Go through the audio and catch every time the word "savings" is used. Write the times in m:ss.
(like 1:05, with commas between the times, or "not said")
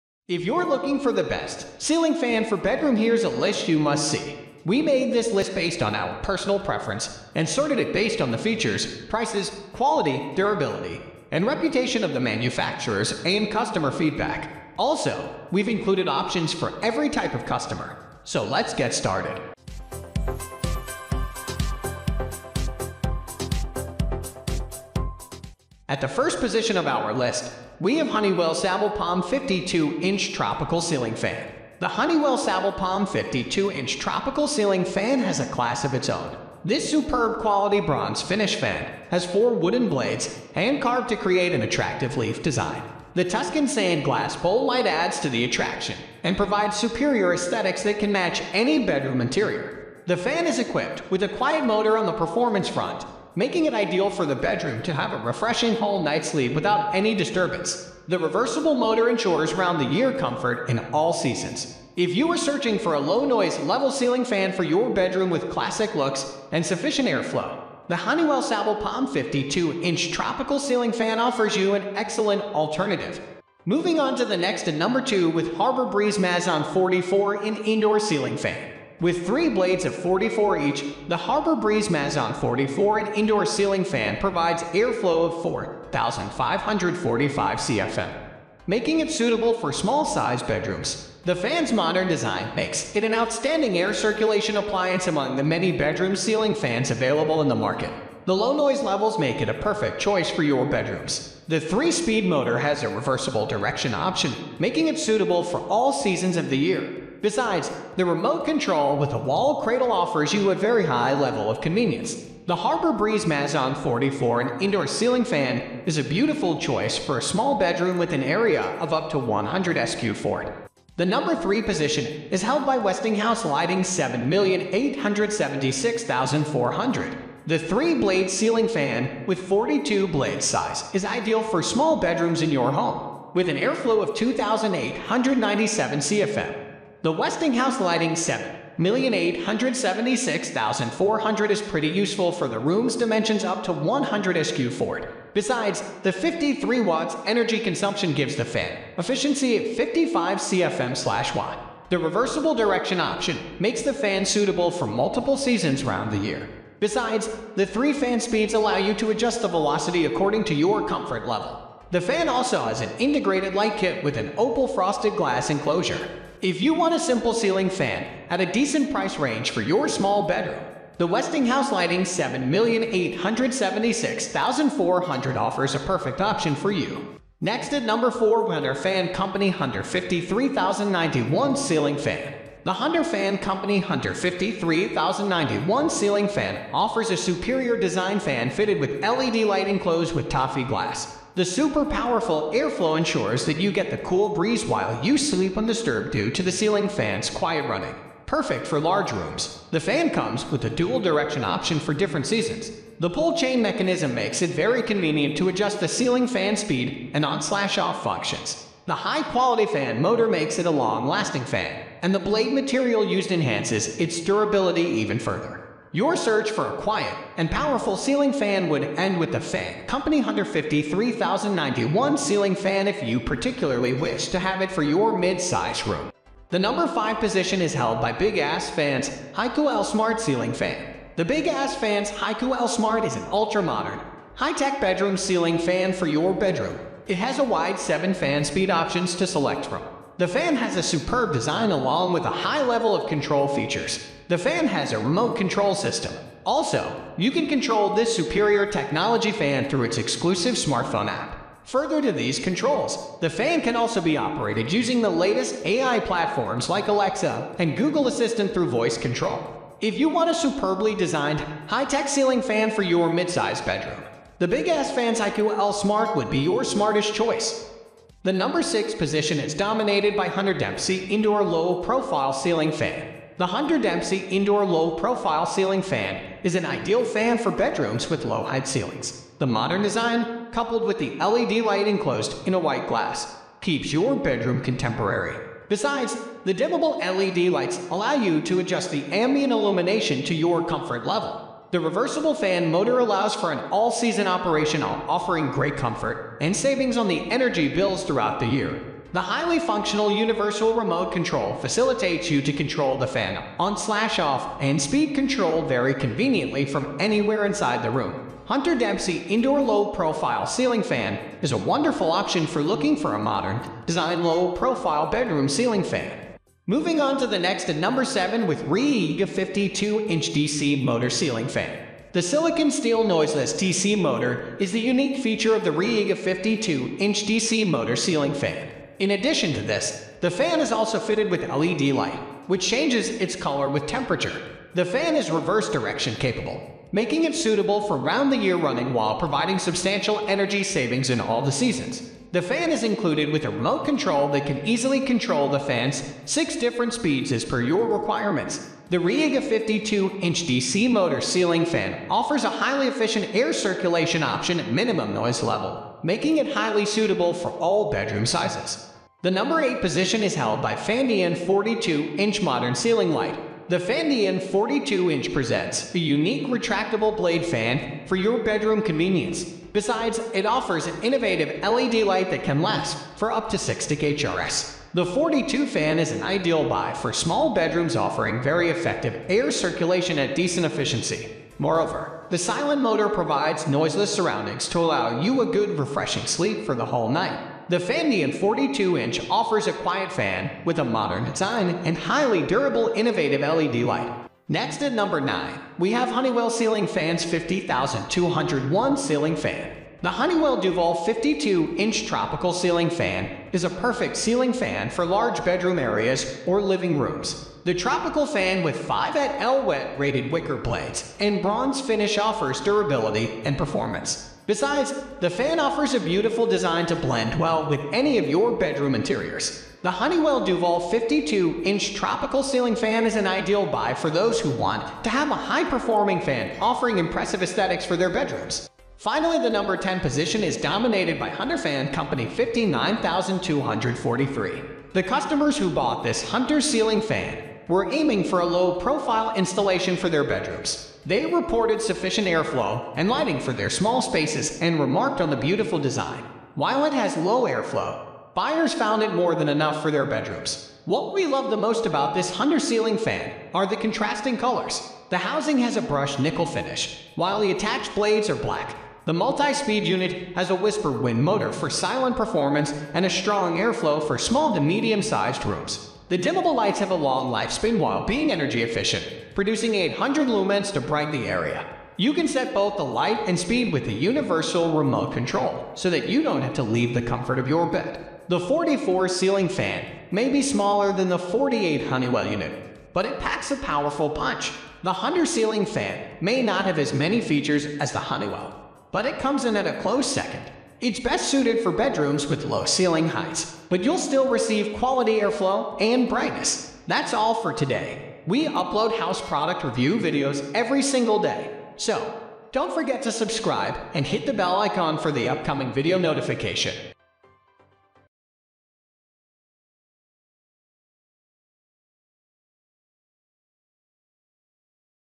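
4:56, 5:40.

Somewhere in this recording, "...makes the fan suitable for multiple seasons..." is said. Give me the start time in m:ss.
2:33.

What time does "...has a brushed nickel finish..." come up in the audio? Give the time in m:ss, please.
7:35.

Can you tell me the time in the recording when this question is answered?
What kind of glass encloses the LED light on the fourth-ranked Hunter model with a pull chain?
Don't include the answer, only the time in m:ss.
3:10.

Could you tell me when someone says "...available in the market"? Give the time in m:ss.
1:36.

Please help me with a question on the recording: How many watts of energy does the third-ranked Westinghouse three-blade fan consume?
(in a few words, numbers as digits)
53 watts.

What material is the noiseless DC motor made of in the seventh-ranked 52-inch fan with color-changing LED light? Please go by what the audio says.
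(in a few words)
silicon steel.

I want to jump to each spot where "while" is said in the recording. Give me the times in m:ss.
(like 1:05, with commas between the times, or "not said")
3:14, 5:38, 7:26, 7:37, 7:47.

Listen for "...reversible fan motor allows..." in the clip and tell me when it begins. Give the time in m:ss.
4:51.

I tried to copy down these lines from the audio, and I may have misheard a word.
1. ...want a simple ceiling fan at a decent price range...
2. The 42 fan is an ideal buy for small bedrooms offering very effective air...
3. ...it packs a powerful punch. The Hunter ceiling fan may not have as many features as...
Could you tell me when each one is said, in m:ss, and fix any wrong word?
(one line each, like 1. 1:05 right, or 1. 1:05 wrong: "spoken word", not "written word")
1. 2:46 right
2. 6:14 right
3. 8:03 right.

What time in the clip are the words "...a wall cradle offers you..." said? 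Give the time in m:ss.
1:49.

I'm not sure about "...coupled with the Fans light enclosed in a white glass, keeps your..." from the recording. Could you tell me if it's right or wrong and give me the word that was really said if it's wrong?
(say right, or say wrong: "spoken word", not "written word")
wrong: "LED", not "Fans".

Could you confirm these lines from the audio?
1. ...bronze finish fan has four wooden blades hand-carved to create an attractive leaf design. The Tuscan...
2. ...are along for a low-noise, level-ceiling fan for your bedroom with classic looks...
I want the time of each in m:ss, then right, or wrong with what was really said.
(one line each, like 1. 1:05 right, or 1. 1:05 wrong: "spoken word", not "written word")
1. 0:37 right
2. 1:02 wrong: "searching", not "along".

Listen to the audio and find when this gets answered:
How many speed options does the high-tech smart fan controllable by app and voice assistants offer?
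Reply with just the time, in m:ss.
3:57.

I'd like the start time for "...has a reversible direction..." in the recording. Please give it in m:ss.
1:42.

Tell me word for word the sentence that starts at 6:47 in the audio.
The tropical fan with 5 at L-Wet rated wicker blades and bronze finish offers durability and performance.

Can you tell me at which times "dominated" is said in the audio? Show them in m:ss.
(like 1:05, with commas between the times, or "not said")
4:29, 7:10.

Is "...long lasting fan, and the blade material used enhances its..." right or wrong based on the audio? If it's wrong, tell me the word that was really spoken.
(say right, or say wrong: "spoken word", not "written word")
right.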